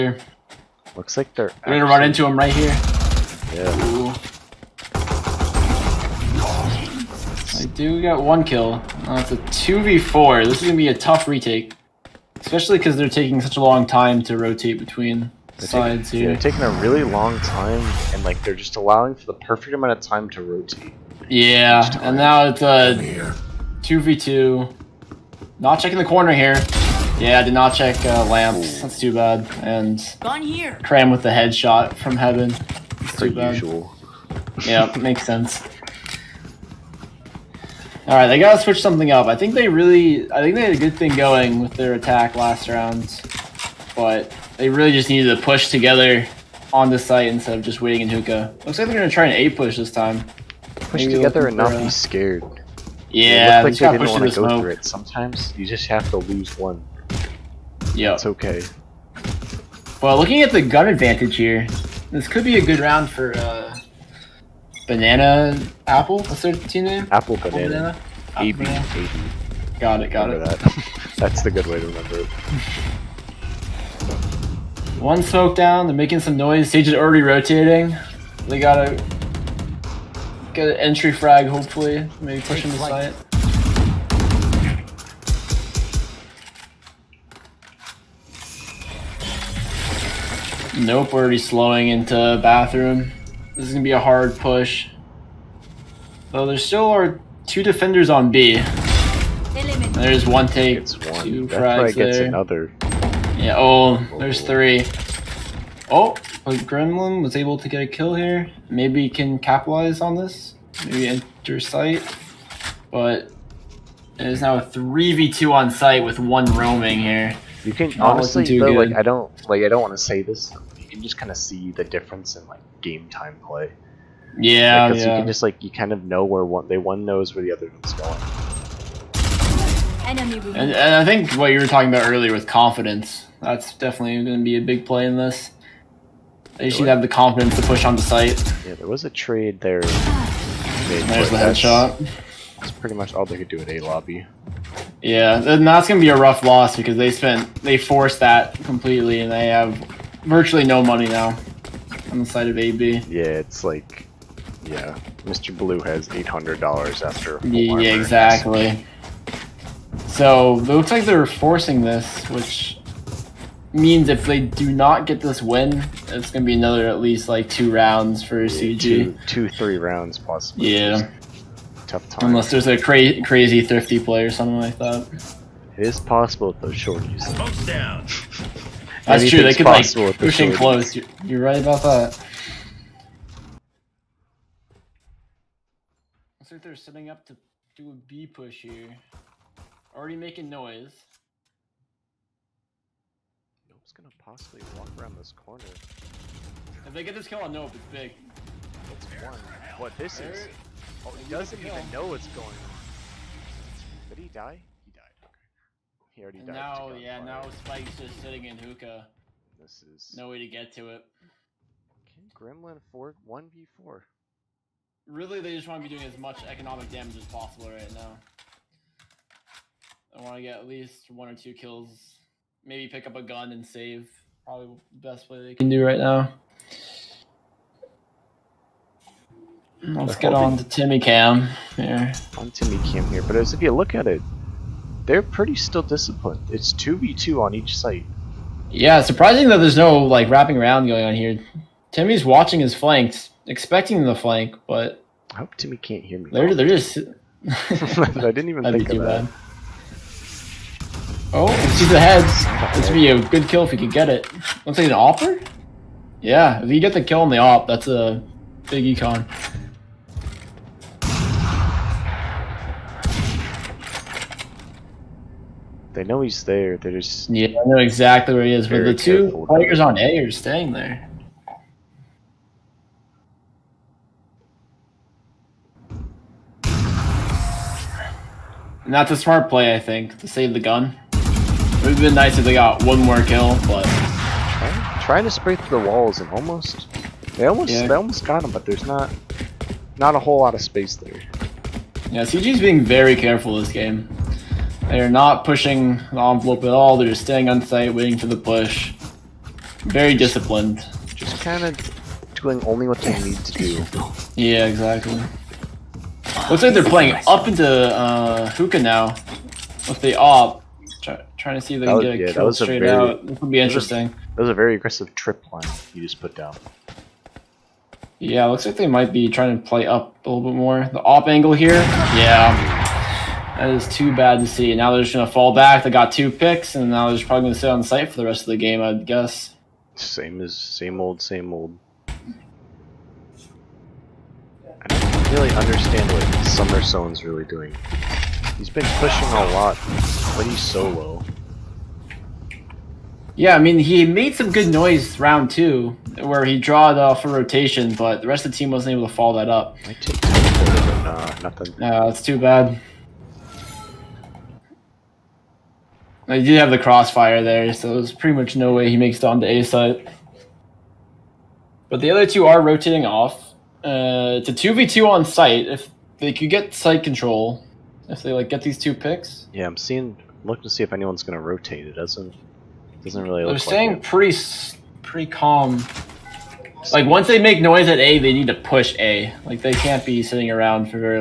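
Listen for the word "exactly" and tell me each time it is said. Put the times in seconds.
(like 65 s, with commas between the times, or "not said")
157 s, 267 s, 304 s.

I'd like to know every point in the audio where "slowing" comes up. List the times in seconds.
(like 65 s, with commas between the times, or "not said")
91 s.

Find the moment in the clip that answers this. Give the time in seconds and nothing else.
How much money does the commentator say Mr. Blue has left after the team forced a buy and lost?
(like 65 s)
156 s.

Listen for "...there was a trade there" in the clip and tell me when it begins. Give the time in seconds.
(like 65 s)
138 s.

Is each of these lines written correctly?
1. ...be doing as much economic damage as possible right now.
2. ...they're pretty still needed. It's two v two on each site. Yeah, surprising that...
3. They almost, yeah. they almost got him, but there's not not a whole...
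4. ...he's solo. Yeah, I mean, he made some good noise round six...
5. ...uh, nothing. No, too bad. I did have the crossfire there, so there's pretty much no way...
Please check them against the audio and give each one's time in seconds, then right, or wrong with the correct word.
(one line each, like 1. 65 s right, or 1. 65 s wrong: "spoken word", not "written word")
1. 215 s right
2. 235 s wrong: "disciplined", not "needed"
3. 287 s right
4. 340 s wrong: "two", not "six"
5. 350 s right.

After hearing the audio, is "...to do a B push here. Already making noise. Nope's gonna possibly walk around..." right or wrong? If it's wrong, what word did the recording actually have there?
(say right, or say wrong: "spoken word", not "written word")
right.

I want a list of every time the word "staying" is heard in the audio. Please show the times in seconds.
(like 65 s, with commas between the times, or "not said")
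270 s, 297 s, 373 s.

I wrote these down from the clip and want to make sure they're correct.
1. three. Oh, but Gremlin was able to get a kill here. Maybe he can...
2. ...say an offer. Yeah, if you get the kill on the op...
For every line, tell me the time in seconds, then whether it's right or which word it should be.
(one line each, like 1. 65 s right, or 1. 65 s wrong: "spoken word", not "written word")
1. 104 s right
2. 254 s right.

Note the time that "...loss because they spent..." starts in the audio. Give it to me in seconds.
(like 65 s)
146 s.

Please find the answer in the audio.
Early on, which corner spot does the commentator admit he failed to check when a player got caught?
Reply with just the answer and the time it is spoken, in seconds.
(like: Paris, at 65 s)
lamps, at 28 s.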